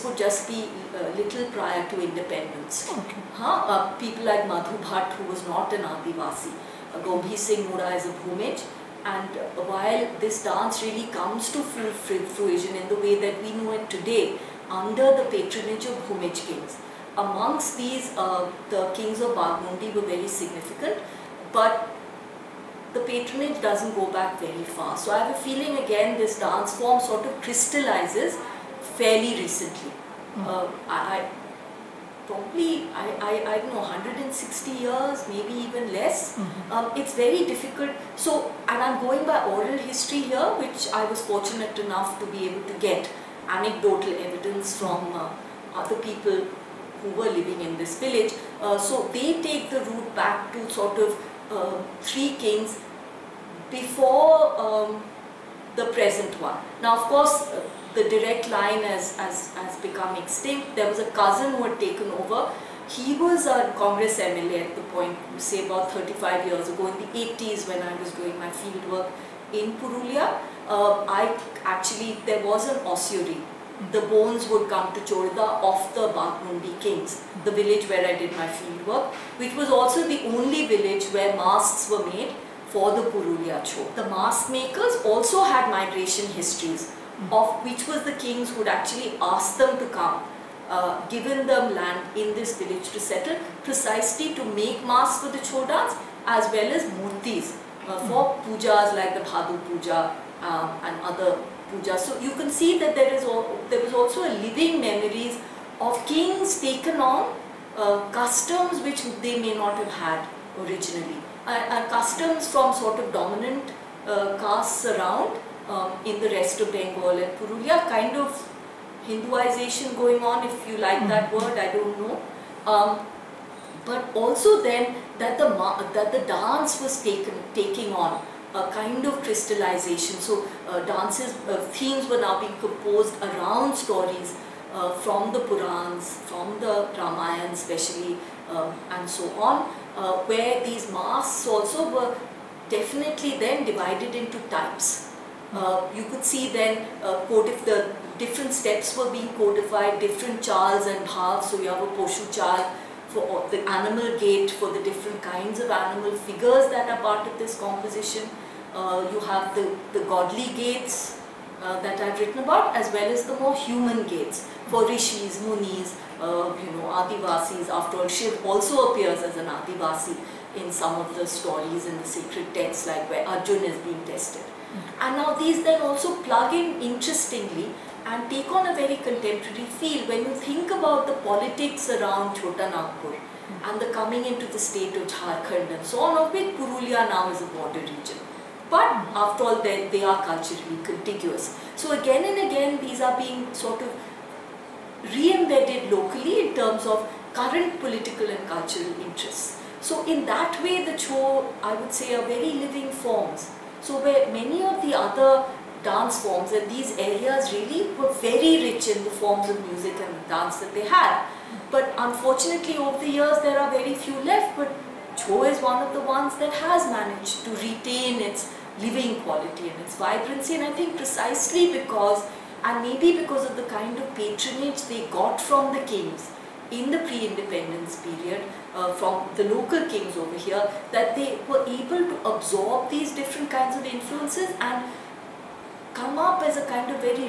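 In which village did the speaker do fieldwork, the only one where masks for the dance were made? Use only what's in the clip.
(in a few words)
Chorda.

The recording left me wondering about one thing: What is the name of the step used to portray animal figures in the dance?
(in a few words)
poshu char.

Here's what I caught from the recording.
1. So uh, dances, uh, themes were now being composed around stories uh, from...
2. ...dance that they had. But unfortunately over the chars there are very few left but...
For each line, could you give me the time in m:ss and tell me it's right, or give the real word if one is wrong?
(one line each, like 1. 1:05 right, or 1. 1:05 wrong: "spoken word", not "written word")
1. 2:10 right
2. 3:30 wrong: "years", not "chars".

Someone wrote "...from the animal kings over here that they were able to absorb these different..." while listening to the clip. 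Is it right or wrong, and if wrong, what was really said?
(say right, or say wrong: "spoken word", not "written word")
wrong: "local", not "animal".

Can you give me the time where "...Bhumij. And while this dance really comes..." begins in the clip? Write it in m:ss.
0:08.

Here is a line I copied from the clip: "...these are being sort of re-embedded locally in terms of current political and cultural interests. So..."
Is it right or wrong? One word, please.
right.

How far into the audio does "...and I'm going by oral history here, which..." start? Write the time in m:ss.
0:38.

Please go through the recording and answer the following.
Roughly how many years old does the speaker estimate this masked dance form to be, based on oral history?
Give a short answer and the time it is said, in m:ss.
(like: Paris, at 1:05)
160 years, at 0:33.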